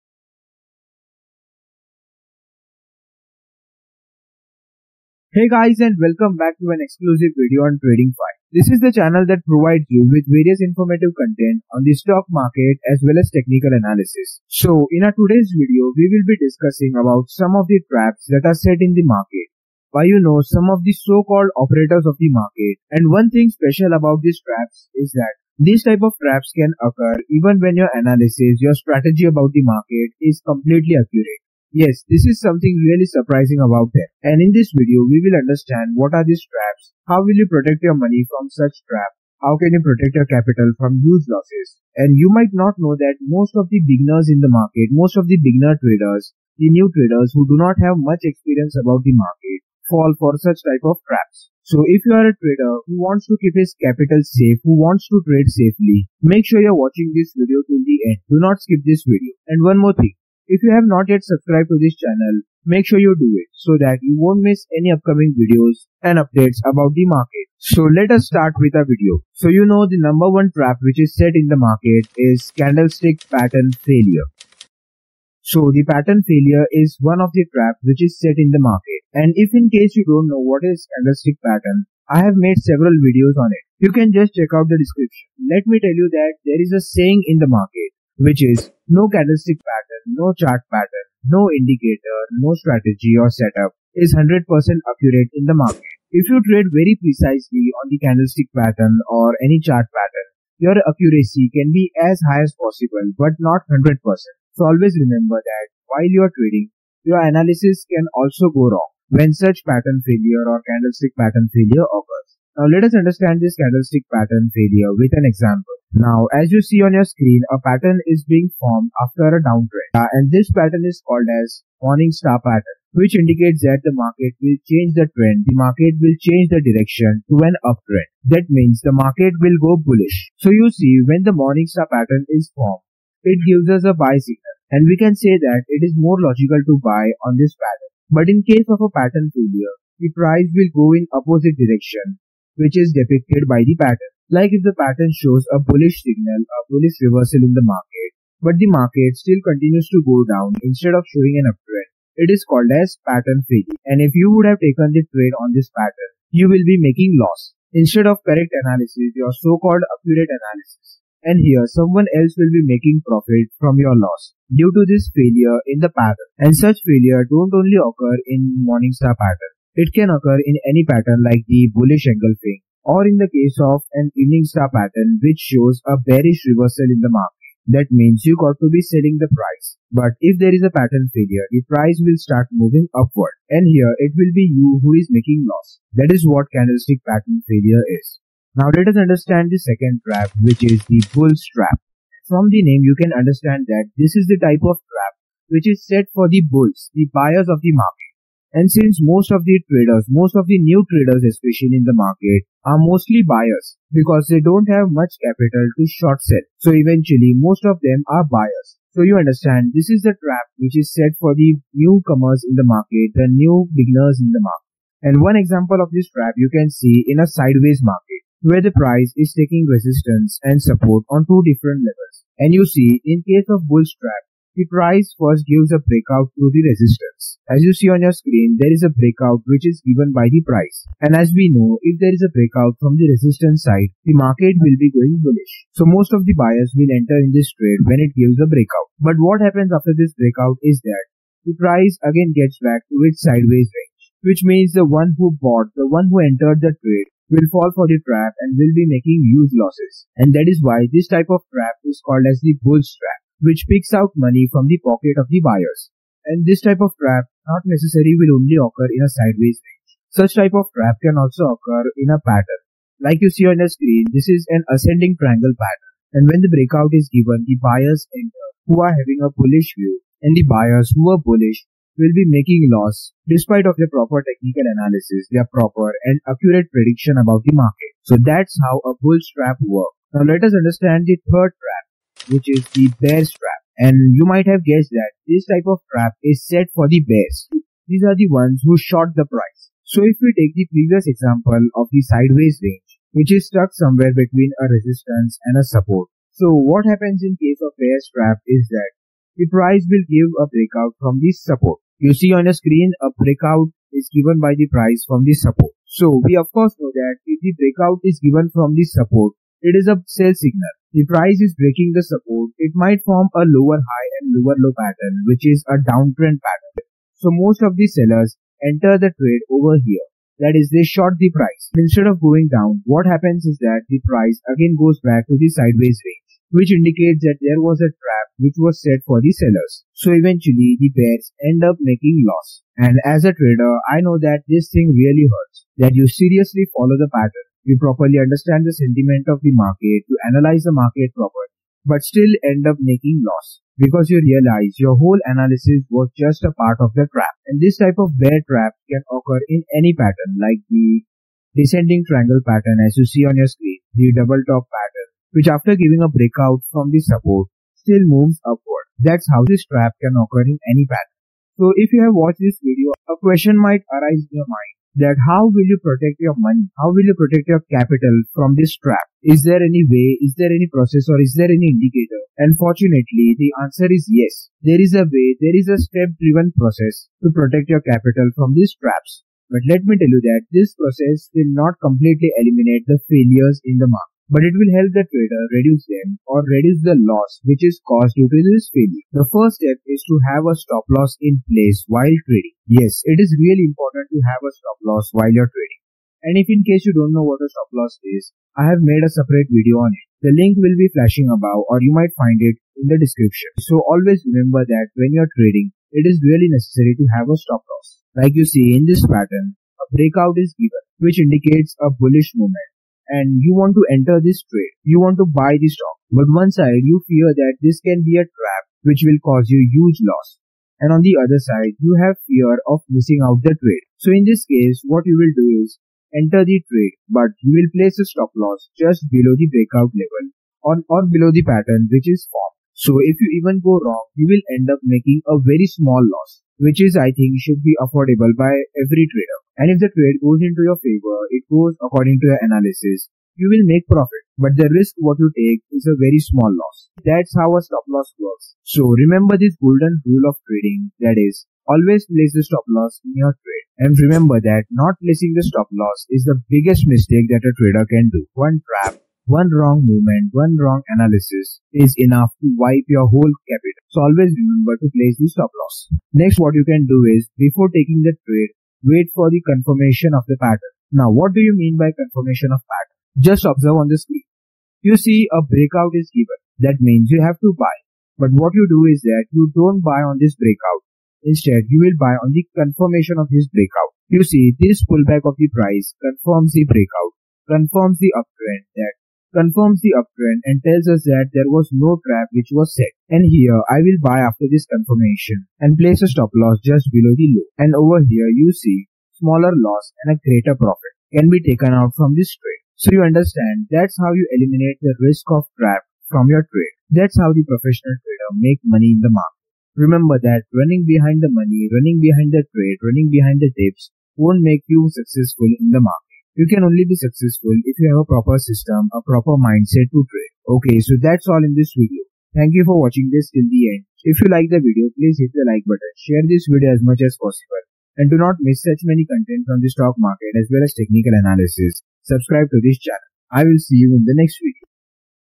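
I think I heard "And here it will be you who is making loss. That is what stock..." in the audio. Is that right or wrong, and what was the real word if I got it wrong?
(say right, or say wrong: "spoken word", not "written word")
wrong: "candlestick", not "stock".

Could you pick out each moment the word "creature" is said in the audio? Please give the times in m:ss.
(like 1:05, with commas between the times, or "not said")
not said.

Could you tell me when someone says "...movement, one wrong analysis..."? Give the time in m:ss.
7:39.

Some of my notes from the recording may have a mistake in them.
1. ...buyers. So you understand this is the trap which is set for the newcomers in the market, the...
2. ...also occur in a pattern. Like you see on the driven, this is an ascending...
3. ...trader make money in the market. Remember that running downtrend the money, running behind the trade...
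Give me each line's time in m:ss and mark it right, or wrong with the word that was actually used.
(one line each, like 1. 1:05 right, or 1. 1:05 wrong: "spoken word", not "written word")
1. 3:28 right
2. 4:21 wrong: "screen", not "driven"
3. 8:28 wrong: "behind", not "downtrend".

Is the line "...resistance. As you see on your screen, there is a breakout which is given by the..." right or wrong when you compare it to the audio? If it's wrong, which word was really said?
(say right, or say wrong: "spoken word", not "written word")
right.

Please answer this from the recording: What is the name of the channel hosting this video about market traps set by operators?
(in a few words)
Tradingfyive.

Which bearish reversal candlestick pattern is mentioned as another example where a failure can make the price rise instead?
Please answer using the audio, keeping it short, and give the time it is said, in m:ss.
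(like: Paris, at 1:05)
Evening star, at 2:54.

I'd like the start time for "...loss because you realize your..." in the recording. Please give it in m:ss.
5:43.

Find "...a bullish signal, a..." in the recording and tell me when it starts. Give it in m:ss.
2:25.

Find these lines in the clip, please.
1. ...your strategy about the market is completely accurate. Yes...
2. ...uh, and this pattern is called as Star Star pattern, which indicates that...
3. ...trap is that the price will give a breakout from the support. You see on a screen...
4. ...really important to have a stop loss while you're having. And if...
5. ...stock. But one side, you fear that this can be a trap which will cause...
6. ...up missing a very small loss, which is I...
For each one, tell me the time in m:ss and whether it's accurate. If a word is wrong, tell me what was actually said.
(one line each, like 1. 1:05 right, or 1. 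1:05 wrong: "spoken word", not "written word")
1. 0:28 right
2. 1:59 wrong: "Morning", not "Star"
3. 4:58 right
4. 6:33 wrong: "trading", not "having"
5. 6:55 right
6. 7:14 wrong: "making", not "missing".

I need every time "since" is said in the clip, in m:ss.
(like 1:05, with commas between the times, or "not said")
3:18.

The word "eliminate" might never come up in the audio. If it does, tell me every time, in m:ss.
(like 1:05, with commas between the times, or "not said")
6:22, 8:24.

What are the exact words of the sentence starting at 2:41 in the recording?
And here someone else will be making profit from your loss due to this failure in the pattern.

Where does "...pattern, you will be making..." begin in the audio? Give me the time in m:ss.
2:35.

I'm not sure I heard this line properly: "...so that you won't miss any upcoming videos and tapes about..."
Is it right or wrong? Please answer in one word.
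wrong.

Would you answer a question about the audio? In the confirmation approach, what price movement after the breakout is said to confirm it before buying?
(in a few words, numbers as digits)
Pullback.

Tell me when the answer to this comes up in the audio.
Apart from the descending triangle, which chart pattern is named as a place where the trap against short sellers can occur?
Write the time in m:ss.
5:54.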